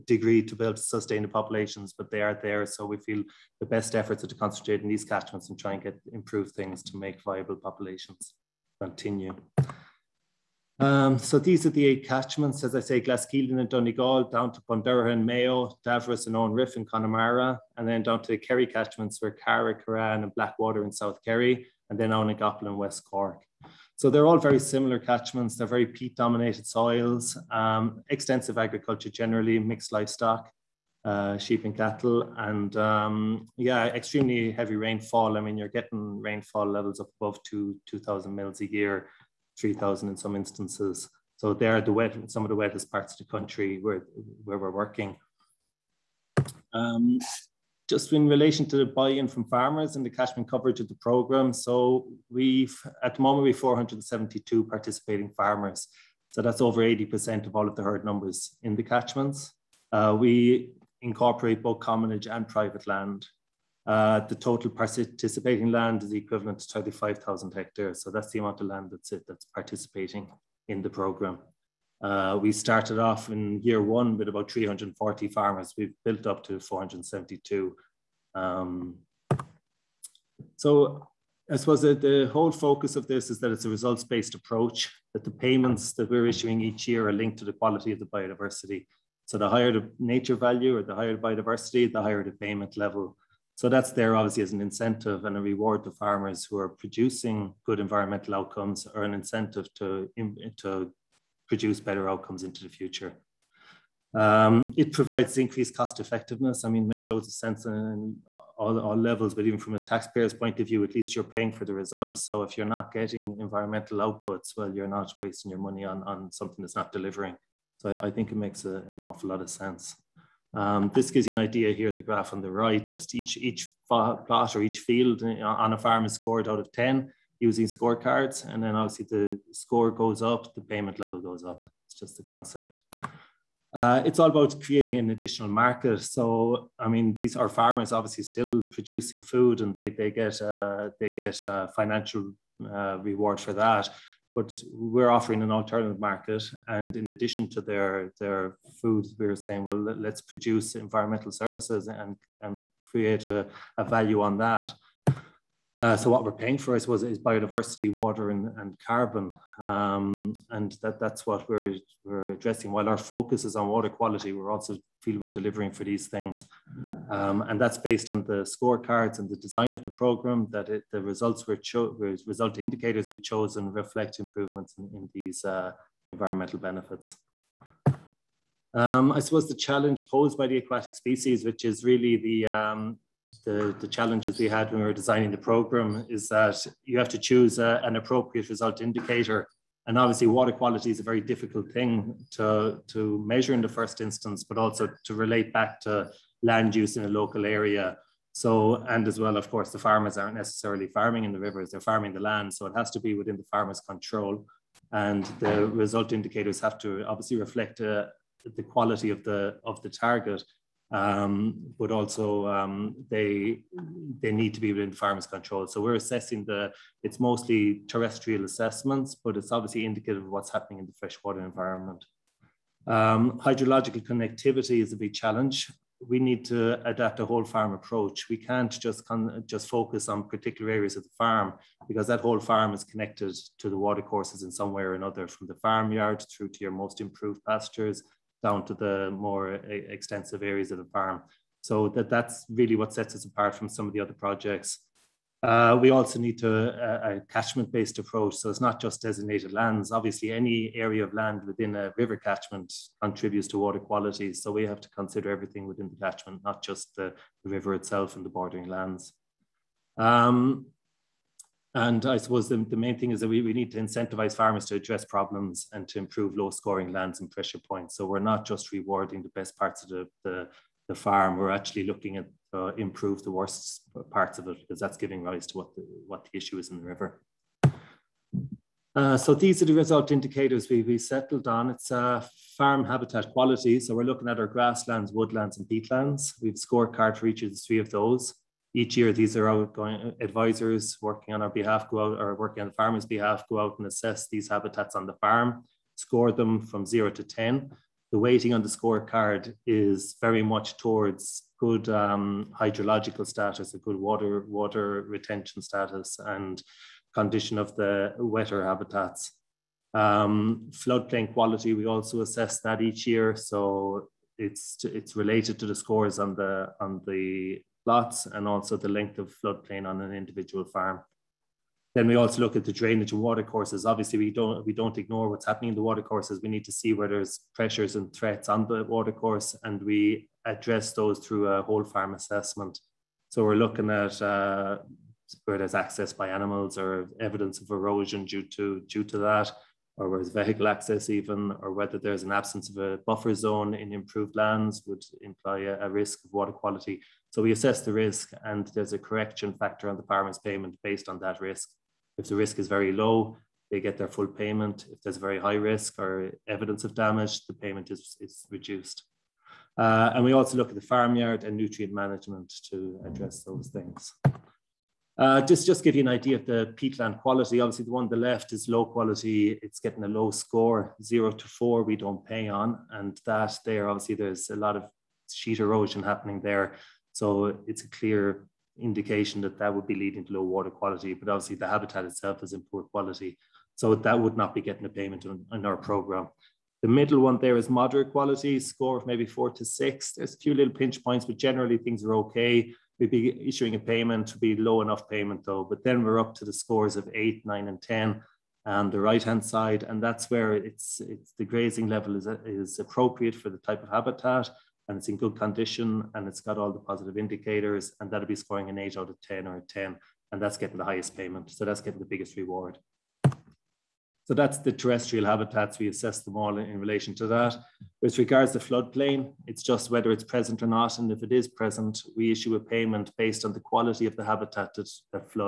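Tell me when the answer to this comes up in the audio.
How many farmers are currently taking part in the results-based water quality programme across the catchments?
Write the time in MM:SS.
00:53.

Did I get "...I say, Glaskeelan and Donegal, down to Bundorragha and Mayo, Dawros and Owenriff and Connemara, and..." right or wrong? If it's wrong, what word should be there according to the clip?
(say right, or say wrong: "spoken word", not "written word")
right.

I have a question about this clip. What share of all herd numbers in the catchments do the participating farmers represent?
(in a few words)
over 80%.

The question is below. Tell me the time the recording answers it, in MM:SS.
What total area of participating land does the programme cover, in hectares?
01:06.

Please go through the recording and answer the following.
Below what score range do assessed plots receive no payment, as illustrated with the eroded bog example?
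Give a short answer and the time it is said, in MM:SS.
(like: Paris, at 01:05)
0 to 4, at 06:11.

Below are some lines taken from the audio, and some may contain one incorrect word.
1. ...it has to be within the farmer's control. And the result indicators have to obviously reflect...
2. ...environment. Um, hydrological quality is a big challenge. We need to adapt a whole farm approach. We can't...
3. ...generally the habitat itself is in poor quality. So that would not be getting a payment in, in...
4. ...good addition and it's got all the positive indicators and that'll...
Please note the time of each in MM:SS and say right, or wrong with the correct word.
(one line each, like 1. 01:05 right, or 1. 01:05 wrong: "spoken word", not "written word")
1. 03:22 right
2. 03:41 wrong: "connectivity", not "quality"
3. 06:21 wrong: "obviously", not "generally"
4. 06:45 wrong: "condition", not "addition".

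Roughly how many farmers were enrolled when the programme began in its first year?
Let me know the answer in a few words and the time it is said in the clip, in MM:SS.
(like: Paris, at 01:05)
340, at 01:14.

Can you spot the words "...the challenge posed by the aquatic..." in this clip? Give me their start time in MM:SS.
02:59.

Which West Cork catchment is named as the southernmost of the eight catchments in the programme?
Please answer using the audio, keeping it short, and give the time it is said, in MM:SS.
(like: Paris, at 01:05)
Ownagappul, at 00:22.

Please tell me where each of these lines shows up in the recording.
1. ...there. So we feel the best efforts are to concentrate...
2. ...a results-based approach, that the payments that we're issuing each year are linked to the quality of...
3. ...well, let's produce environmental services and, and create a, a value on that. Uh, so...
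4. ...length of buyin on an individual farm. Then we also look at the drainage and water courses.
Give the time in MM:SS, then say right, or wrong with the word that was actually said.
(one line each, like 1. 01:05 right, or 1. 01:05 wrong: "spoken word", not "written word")
1. 00:02 right
2. 01:23 right
3. 02:29 right
4. 05:18 wrong: "floodplain", not "buyin".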